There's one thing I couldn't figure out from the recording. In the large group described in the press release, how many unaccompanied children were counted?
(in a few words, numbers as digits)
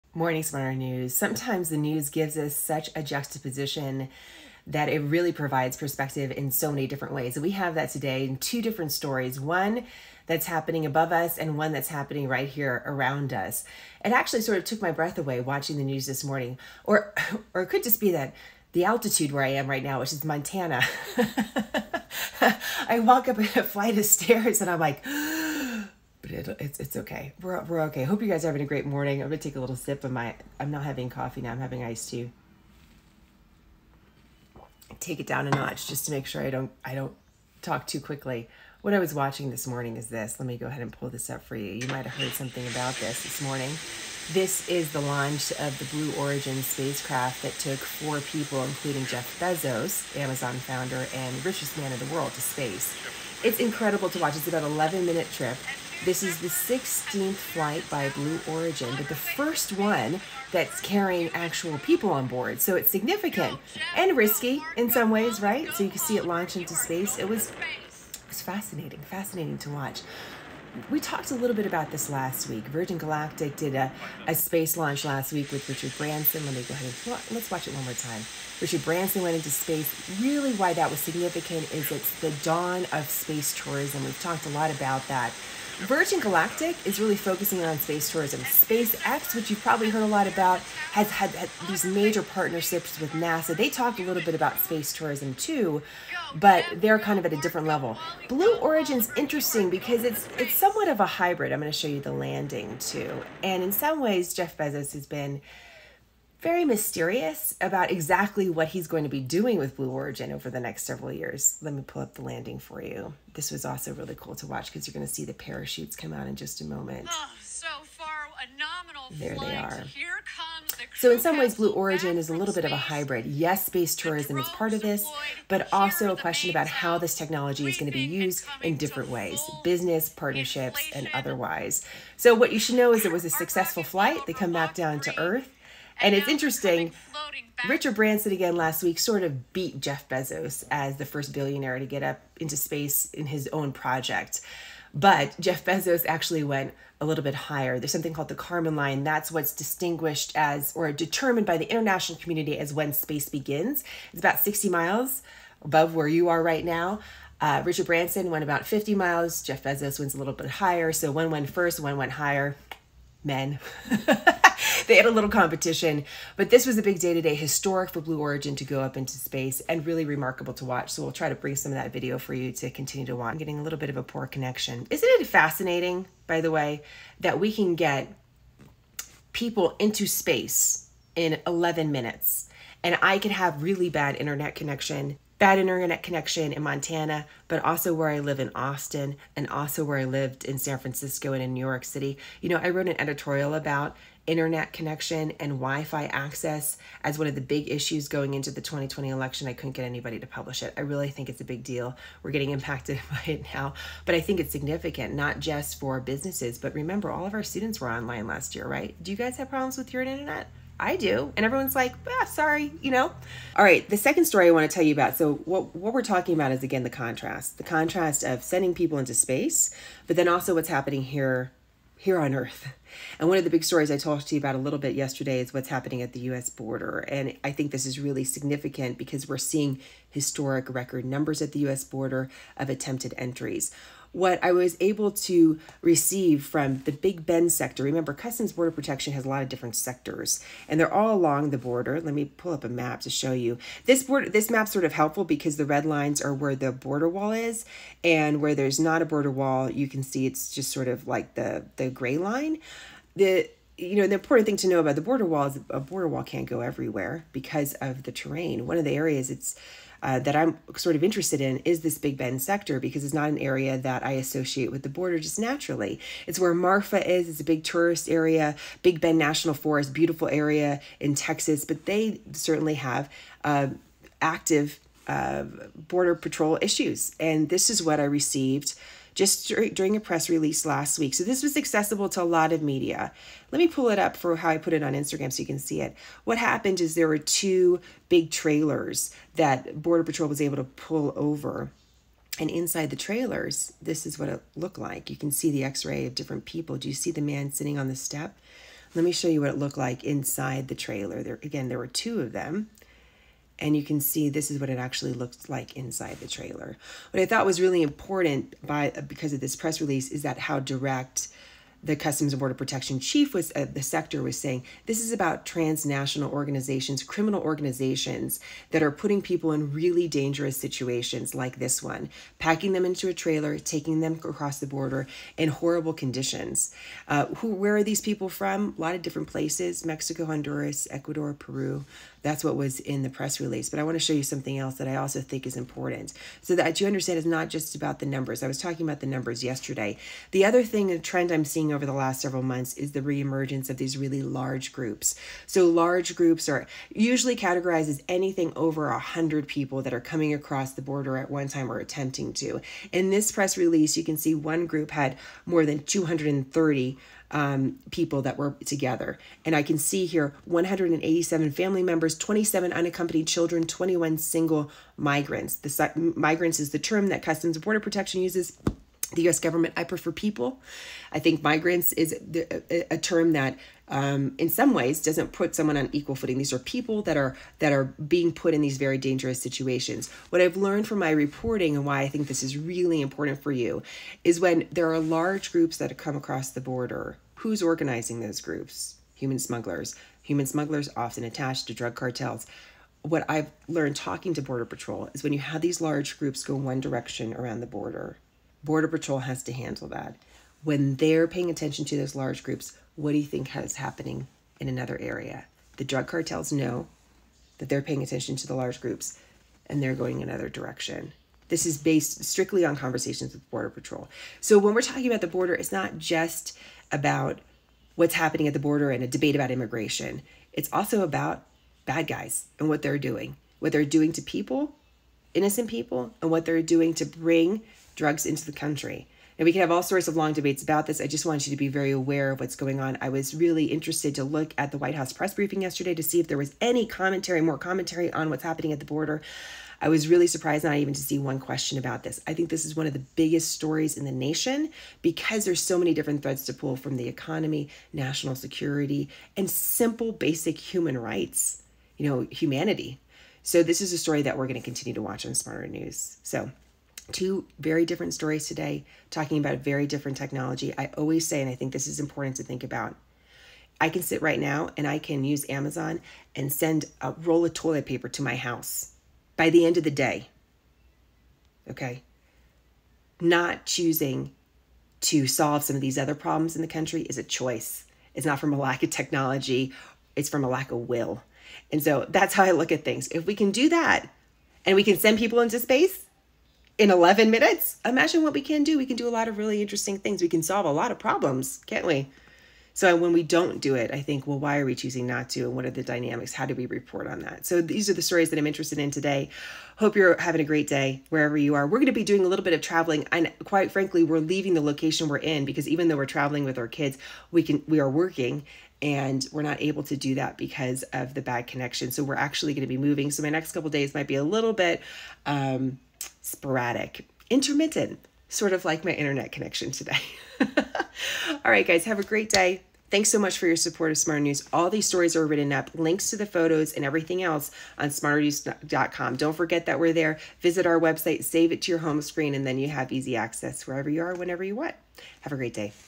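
27.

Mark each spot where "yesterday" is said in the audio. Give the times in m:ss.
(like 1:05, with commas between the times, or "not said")
3:44, 5:39, 7:15.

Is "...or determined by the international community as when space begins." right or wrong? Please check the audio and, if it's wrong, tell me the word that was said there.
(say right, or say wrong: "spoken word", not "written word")
right.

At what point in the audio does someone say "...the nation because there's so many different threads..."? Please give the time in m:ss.
7:24.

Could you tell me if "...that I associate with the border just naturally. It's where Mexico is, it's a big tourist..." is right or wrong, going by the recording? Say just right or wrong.
wrong.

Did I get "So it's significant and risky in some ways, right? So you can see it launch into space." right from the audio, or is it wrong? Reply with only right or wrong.
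right.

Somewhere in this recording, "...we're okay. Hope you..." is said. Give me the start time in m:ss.
0:27.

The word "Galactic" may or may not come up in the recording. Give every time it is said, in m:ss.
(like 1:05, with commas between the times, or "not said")
1:12, 1:26.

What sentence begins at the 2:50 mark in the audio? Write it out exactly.
So we'll try to bring some of that video for you to continue to watch.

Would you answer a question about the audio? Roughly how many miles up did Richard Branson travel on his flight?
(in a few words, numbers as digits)
50 miles.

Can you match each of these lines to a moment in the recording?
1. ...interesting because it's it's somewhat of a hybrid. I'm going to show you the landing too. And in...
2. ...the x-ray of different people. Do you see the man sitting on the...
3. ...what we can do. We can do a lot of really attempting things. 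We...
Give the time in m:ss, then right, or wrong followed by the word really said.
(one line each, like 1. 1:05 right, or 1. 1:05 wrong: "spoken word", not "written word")
1. 1:39 right
2. 4:55 right
3. 8:08 wrong: "interesting", not "attempting".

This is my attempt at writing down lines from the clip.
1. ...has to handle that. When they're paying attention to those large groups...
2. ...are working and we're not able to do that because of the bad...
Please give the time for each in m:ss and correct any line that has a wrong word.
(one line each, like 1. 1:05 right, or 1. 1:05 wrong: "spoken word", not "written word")
1. 6:39 right
2. 8:27 right.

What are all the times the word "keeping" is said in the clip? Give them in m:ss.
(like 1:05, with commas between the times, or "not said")
not said.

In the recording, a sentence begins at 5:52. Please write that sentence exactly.
In this press release, you can see one group had more than 230 um, people that were together.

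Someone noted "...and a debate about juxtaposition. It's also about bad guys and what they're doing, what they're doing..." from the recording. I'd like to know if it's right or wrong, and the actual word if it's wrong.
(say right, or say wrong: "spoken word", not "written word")
wrong: "immigration", not "juxtaposition".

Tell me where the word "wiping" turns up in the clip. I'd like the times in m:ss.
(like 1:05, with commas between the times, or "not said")
not said.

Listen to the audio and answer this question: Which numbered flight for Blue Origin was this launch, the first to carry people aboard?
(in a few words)
16th.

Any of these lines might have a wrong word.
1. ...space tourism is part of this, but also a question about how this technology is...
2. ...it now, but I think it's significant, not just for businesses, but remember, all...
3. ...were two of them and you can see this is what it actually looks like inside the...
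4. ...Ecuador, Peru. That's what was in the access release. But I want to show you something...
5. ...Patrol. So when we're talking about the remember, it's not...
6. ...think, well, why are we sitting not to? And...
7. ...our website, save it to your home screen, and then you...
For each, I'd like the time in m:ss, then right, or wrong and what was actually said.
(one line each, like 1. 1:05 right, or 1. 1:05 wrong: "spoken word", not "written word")
1. 2:03 right
2. 3:23 right
3. 5:01 right
4. 5:30 wrong: "press", not "access"
5. 6:53 wrong: "border", not "remember"
6. 8:14 wrong: "choosing", not "sitting"
7. 8:50 right.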